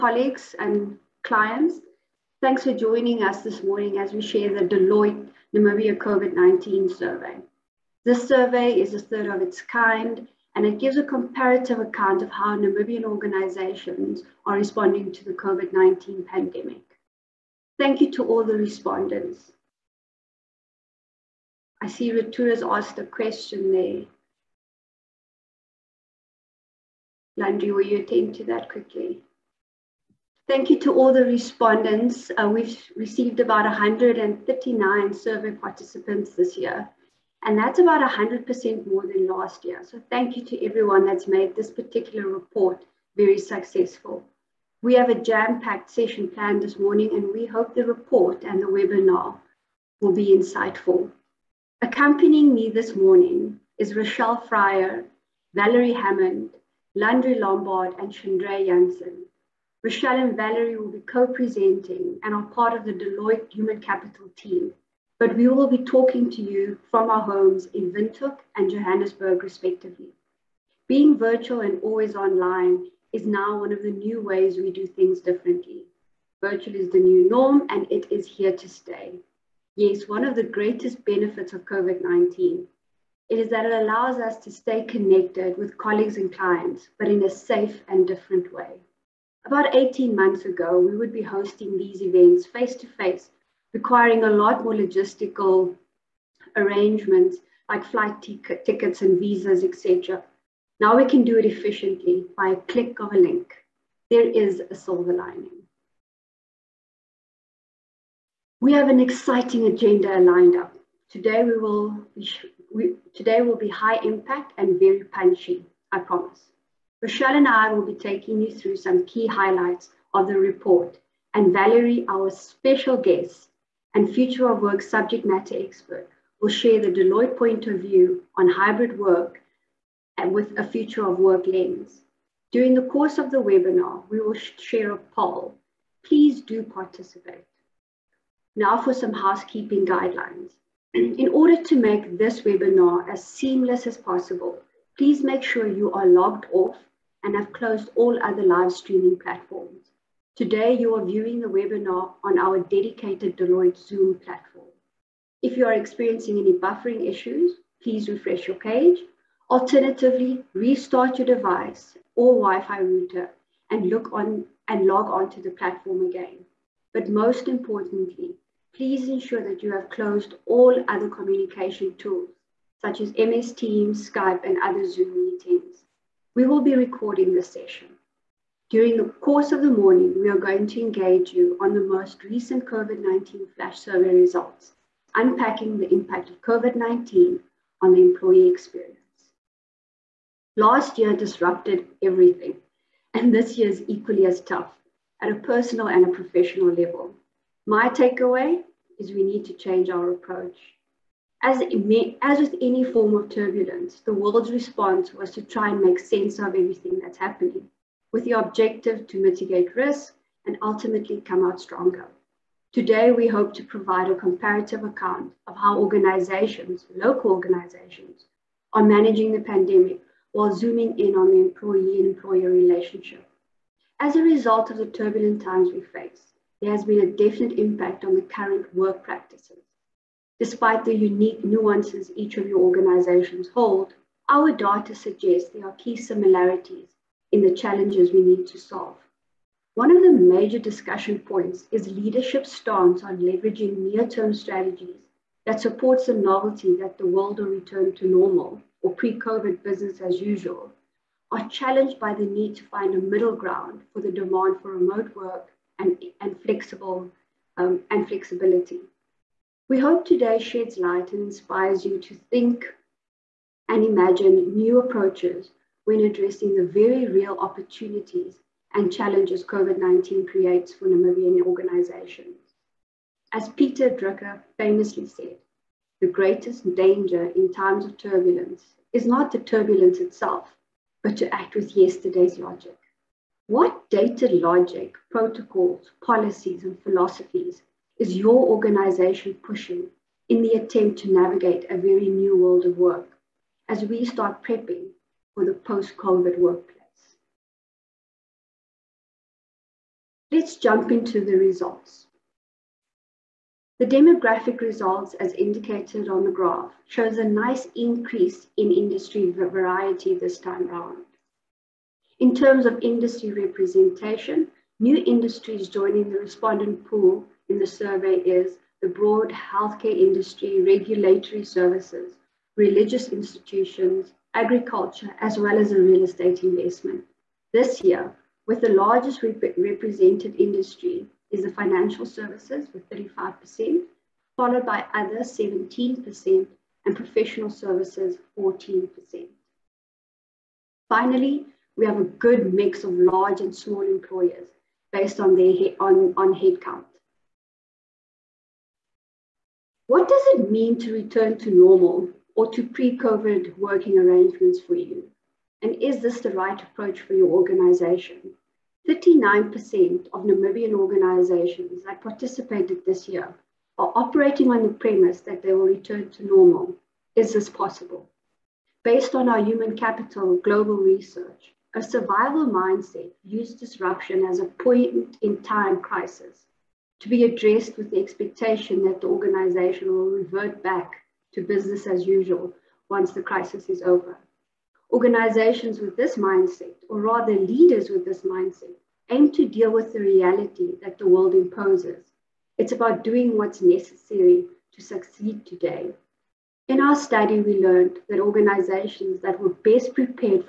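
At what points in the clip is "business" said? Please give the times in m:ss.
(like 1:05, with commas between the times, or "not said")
4:09, 6:21.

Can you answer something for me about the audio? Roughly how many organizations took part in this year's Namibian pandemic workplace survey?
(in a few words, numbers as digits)
139.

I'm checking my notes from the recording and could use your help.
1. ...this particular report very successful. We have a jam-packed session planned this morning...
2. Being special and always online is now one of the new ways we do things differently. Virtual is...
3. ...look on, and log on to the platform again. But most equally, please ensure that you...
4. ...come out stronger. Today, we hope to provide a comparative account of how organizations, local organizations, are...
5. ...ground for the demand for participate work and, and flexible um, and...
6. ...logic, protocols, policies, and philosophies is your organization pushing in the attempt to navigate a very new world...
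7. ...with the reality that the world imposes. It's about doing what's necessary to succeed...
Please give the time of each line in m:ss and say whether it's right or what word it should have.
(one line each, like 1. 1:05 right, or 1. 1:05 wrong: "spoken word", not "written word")
1. 0:41 right
2. 1:10 wrong: "virtual", not "special"
3. 2:43 wrong: "importantly", not "equally"
4. 3:31 right
5. 4:13 wrong: "remote", not "participate"
6. 4:44 right
7. 6:29 right.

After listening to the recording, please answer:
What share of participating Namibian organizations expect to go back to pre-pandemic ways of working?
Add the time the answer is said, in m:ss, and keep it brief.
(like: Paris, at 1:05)
39%, at 5:58.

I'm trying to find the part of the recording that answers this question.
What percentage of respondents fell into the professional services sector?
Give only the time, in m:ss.
5:38.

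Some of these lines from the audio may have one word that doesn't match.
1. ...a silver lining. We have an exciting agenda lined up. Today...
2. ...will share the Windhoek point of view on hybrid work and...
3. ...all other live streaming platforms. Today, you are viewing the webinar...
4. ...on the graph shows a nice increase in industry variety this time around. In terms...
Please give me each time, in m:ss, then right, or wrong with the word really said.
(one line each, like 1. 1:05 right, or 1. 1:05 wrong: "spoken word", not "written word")
1. 1:44 right
2. 2:06 wrong: "Deloitte", not "Windhoek"
3. 2:27 right
4. 5:06 right.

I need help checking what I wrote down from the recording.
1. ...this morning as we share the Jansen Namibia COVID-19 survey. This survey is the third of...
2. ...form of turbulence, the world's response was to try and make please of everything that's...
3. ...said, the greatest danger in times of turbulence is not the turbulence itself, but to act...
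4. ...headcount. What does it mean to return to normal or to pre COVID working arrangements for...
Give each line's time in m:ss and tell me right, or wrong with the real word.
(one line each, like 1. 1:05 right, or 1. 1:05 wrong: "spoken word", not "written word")
1. 0:03 wrong: "Deloitte", not "Jansen"
2. 3:22 wrong: "sense", not "please"
3. 4:35 right
4. 5:46 right.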